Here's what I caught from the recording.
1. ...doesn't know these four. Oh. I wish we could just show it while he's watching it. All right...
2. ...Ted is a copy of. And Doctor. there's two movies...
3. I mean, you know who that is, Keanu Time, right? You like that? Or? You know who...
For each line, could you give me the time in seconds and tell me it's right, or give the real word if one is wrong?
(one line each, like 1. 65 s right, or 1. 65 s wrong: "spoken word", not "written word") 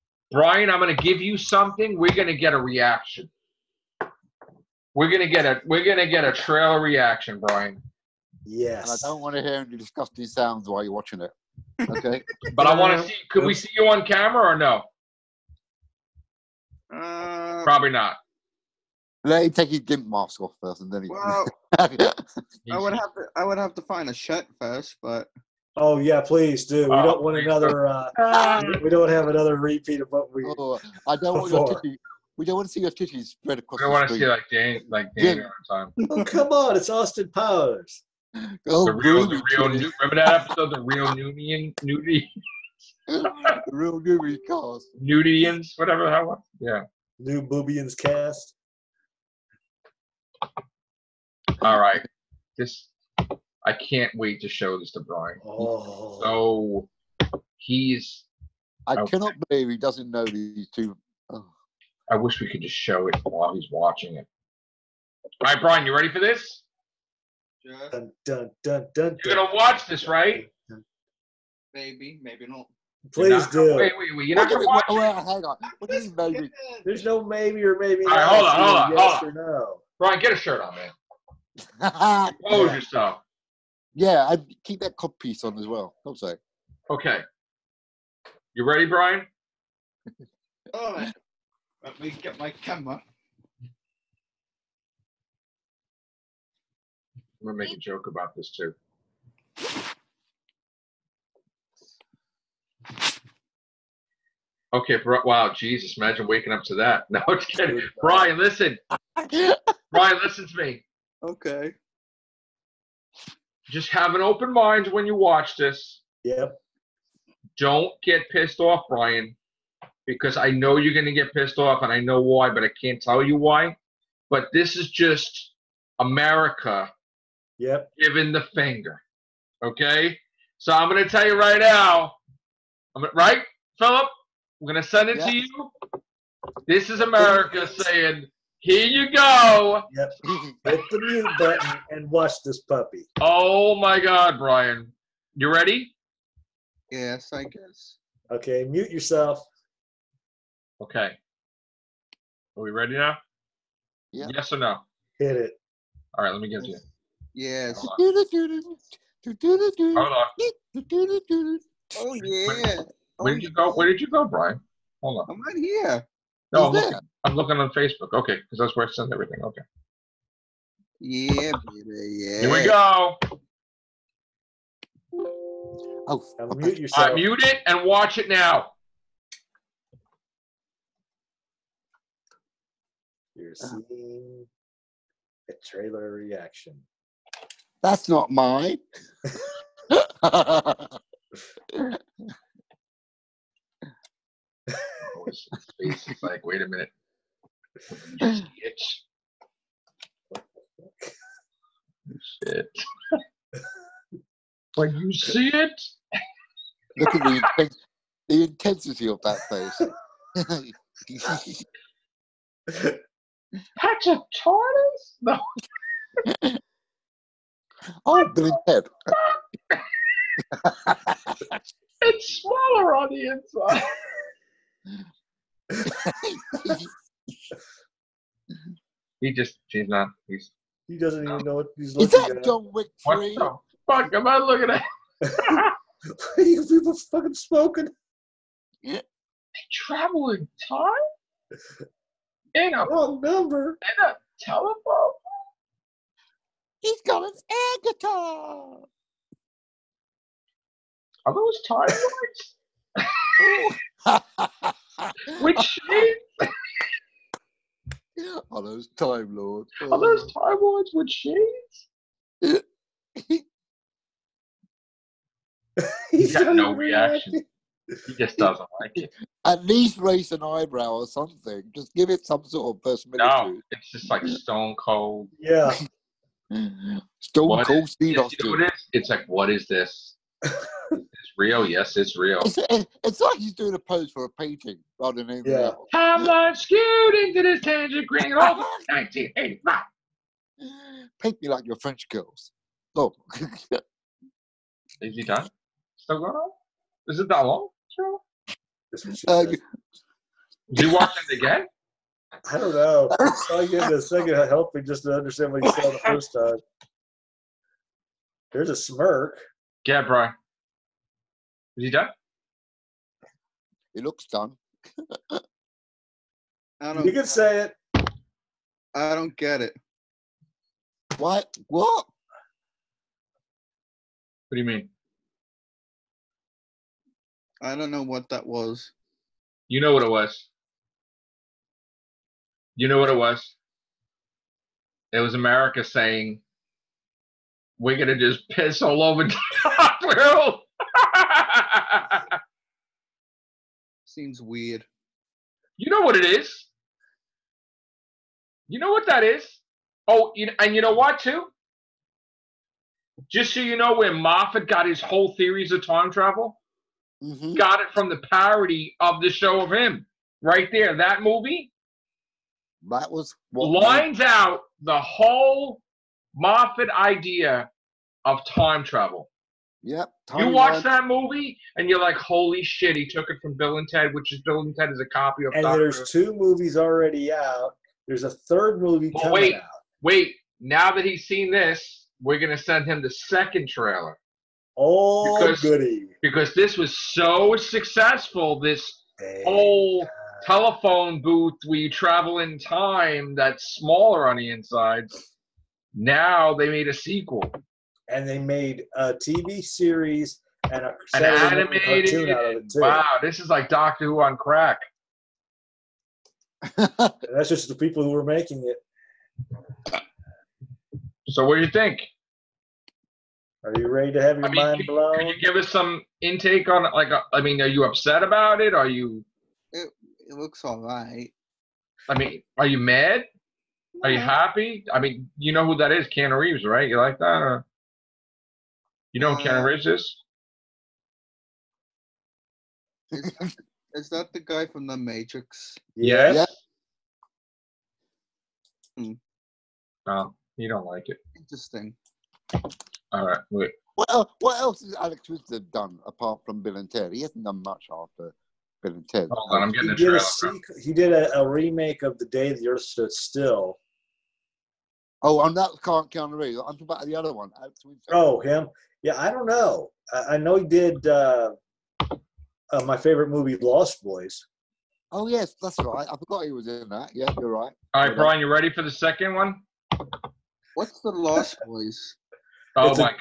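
1. 59 s wrong: "two", not "four"
2. 374 s right
3. 424 s wrong: "Reeves", not "Time".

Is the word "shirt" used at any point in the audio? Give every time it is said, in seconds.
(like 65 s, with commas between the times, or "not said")
24 s, 80 s.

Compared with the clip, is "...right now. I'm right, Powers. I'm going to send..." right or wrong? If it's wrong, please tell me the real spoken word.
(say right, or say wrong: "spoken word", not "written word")
wrong: "Philip", not "Powers".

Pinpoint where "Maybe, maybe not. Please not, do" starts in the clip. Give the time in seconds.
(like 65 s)
71 s.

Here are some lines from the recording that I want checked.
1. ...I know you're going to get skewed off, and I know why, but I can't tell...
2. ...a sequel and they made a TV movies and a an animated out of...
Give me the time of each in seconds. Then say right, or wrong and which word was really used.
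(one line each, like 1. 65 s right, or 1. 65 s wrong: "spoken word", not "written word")
1. 120 s wrong: "pissed", not "skewed"
2. 396 s wrong: "series", not "movies".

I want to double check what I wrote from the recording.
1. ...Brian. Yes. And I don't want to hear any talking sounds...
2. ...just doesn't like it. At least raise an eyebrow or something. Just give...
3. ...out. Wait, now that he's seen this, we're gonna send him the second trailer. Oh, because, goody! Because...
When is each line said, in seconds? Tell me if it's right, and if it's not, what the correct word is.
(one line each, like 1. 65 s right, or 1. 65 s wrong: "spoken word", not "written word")
1. 7 s wrong: "disgusting", not "talking"
2. 268 s right
3. 379 s right.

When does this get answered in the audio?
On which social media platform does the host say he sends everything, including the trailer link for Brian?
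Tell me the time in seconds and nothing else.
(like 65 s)
167 s.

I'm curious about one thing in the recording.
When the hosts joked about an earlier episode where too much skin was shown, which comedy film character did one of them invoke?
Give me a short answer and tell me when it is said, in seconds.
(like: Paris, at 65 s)
Austin Powers, at 36 s.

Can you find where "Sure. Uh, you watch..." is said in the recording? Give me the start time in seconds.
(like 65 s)
297 s.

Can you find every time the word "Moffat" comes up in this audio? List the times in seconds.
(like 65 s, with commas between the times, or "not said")
354 s, 366 s.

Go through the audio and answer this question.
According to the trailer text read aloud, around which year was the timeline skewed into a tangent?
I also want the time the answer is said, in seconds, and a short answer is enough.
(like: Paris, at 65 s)
1985, at 288 s.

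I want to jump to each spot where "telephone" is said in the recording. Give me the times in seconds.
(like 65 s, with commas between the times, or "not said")
244 s, 390 s.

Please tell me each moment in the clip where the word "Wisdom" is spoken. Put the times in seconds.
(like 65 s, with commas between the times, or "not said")
445 s.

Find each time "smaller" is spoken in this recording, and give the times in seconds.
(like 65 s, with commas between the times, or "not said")
222 s, 393 s.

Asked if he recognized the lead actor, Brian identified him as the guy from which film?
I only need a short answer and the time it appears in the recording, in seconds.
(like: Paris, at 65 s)
The Matrix, at 434 s.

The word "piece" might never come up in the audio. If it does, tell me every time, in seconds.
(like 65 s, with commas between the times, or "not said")
85 s.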